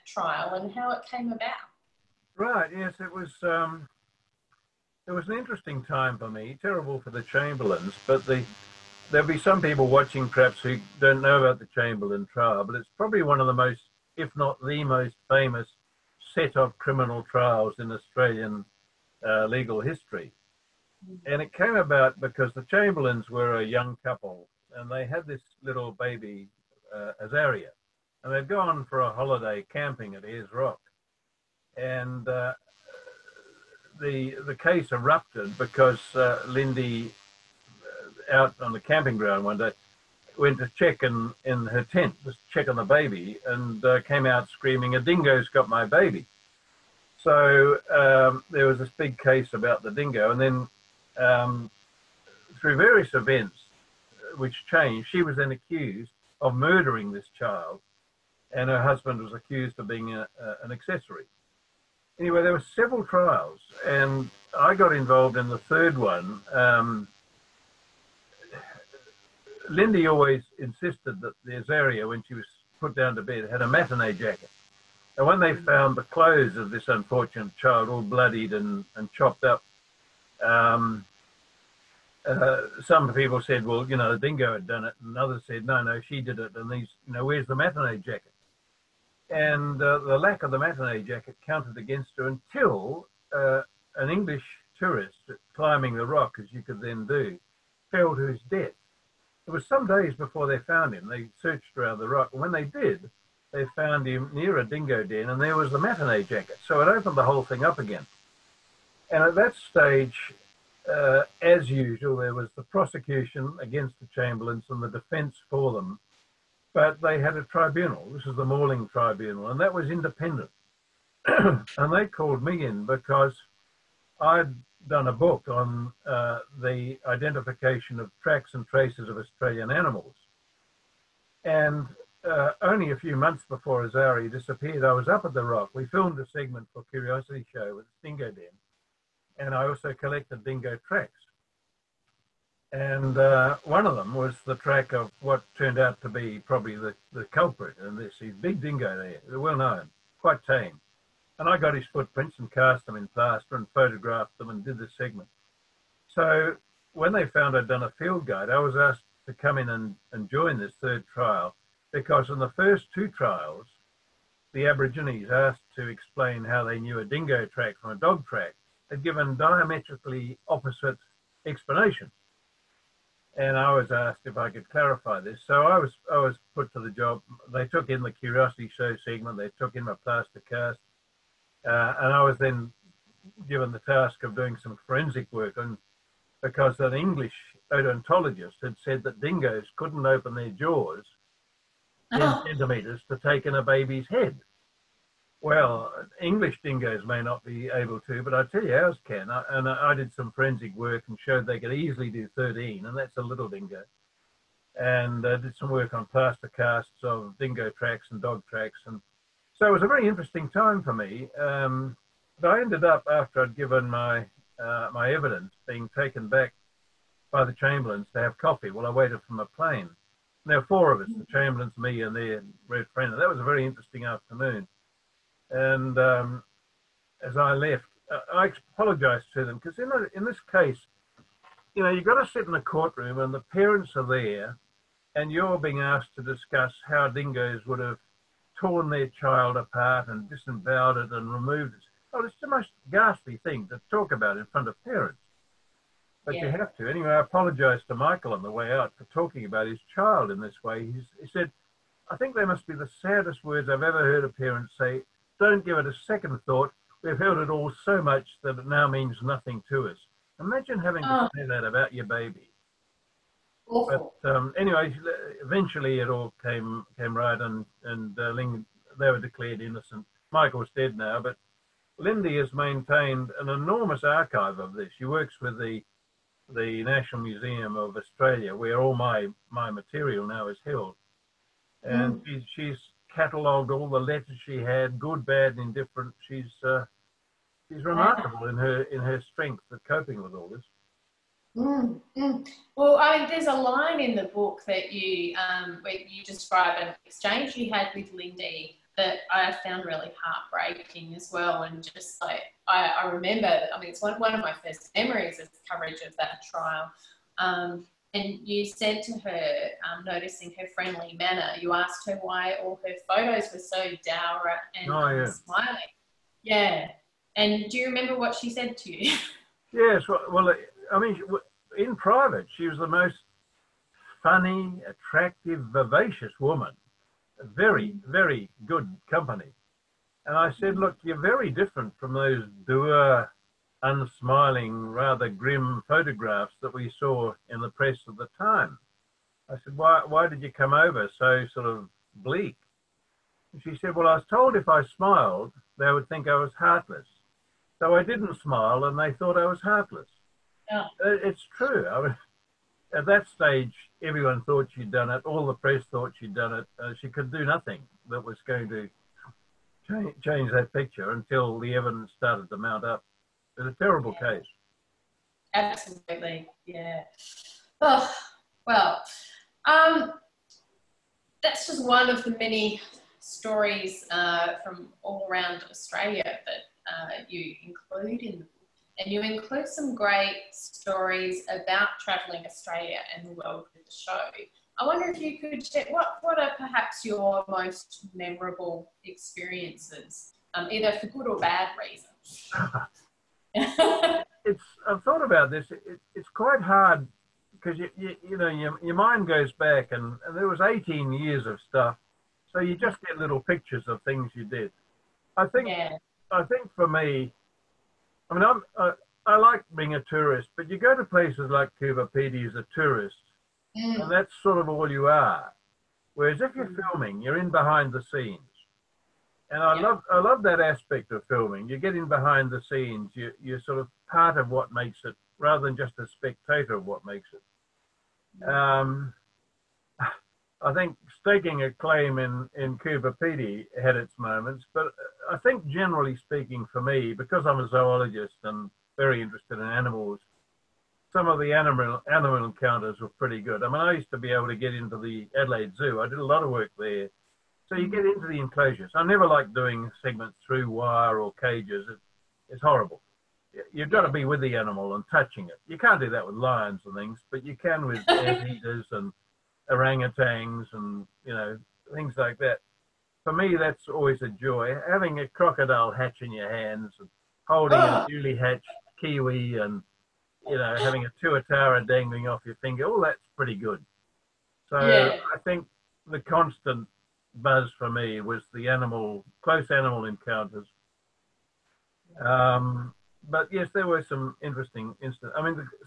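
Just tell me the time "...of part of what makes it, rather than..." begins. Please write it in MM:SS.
07:03.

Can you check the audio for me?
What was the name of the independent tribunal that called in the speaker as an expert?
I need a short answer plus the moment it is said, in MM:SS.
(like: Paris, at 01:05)
Morling Tribunal, at 01:58.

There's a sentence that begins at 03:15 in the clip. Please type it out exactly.
Well, English dingoes may not be able to, but I tell you, ours can.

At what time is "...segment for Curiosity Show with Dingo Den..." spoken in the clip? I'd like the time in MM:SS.
02:16.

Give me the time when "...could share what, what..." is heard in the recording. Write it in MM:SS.
06:25.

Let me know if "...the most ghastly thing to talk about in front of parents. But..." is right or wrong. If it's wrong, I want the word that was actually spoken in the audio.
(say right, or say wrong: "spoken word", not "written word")
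right.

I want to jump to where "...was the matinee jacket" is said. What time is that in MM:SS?
01:45.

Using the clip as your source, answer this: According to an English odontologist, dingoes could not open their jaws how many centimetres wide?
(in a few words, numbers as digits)
10.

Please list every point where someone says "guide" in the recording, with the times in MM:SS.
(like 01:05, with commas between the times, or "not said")
02:38.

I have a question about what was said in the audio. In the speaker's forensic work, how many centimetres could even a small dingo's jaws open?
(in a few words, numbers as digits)
13.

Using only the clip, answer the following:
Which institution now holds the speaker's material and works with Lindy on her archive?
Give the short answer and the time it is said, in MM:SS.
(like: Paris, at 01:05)
National Museum of Australia, at 04:36.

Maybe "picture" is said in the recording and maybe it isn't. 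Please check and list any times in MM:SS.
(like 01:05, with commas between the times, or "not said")
06:00, 06:43.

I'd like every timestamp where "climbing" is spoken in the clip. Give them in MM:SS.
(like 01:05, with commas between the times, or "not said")
01:35.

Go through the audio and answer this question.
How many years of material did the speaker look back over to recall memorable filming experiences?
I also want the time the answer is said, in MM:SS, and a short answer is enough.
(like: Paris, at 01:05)
18, at 06:40.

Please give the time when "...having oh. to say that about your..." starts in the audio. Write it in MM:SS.
04:20.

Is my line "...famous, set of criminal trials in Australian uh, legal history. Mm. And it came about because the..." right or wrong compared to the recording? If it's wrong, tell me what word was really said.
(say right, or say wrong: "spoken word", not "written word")
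right.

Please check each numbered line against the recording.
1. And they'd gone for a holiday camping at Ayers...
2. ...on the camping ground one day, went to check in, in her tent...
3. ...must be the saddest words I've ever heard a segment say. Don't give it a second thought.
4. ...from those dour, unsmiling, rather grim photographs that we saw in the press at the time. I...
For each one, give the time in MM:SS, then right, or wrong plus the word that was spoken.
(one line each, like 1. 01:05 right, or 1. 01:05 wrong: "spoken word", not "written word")
1. 00:28 right
2. 00:38 right
3. 04:12 wrong: "parent", not "segment"
4. 05:31 right.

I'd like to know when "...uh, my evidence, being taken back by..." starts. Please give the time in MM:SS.
03:34.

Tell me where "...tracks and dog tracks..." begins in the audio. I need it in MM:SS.
03:27.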